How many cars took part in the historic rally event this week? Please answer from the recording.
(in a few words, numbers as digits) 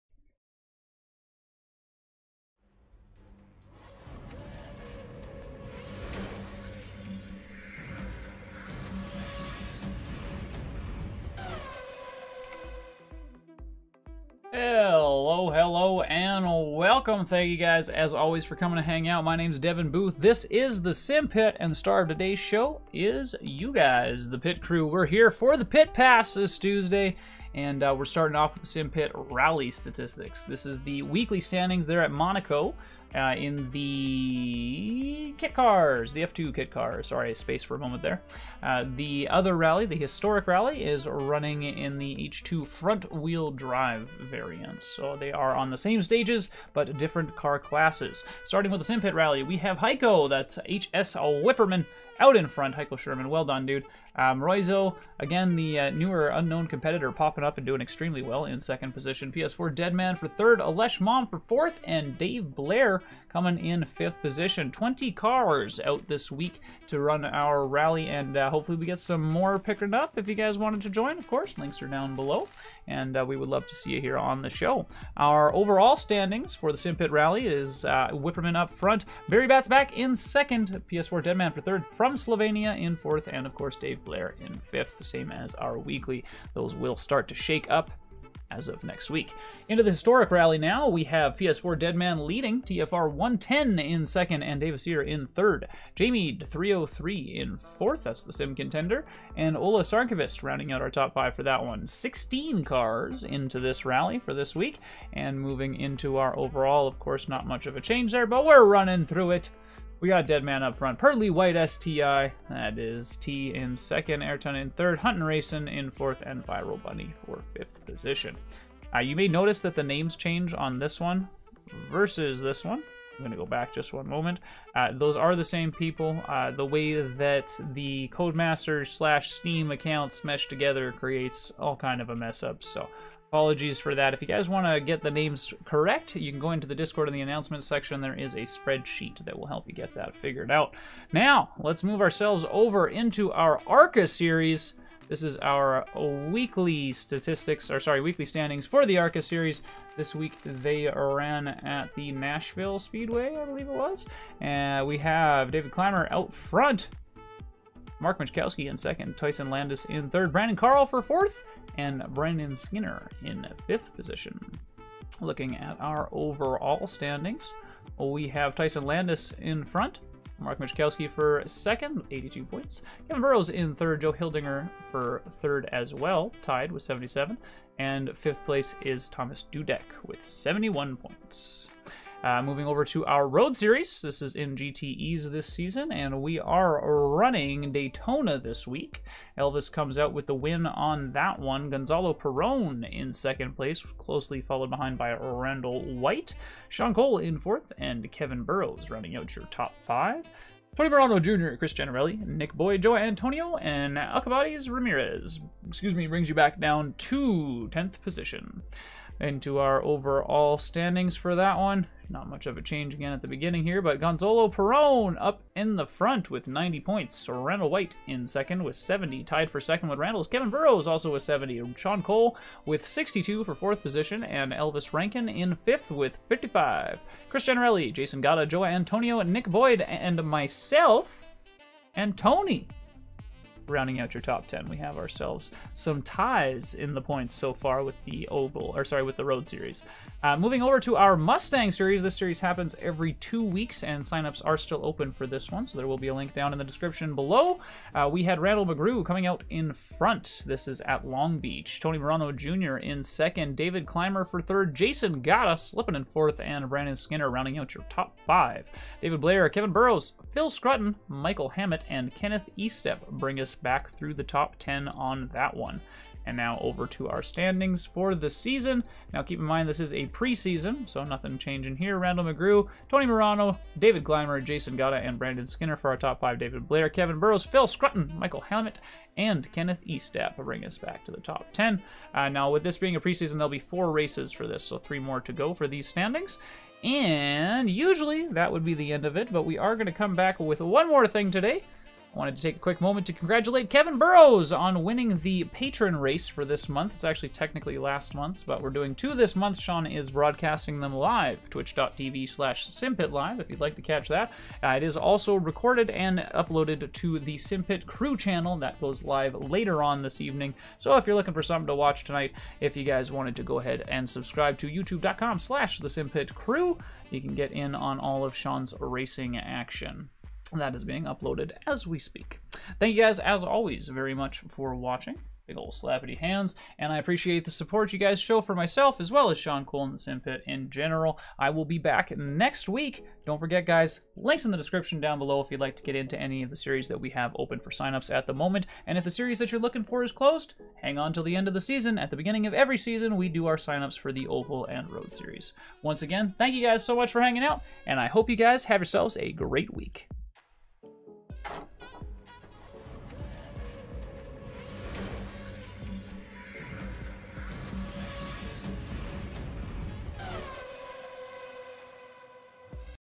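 16.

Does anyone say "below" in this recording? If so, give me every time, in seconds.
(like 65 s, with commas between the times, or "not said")
72 s, 247 s, 335 s.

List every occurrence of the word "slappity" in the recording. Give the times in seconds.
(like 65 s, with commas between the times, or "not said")
325 s.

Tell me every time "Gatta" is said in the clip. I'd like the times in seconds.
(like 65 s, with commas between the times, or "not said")
228 s, 274 s.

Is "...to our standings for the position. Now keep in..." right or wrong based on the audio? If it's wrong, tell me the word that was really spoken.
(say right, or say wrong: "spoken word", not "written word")
wrong: "season", not "position".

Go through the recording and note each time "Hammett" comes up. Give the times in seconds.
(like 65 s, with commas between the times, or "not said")
261 s, 278 s.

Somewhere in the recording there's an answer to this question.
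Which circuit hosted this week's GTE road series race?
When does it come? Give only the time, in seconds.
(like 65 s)
187 s.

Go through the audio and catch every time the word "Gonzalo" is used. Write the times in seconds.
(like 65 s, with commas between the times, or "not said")
191 s, 214 s.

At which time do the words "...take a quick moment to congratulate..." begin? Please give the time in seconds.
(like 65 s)
292 s.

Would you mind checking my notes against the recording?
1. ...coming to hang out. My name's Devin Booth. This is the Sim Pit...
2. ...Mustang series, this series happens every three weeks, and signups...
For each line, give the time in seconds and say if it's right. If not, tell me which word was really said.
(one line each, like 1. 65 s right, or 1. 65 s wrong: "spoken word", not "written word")
1. 18 s right
2. 241 s wrong: "two", not "three".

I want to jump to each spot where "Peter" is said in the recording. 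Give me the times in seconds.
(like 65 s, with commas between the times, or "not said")
not said.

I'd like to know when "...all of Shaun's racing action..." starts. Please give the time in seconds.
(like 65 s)
318 s.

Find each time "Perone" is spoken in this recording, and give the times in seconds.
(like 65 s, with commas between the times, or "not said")
192 s, 214 s.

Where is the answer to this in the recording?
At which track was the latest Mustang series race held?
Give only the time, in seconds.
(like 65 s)
251 s.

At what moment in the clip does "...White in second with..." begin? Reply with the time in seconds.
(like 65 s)
217 s.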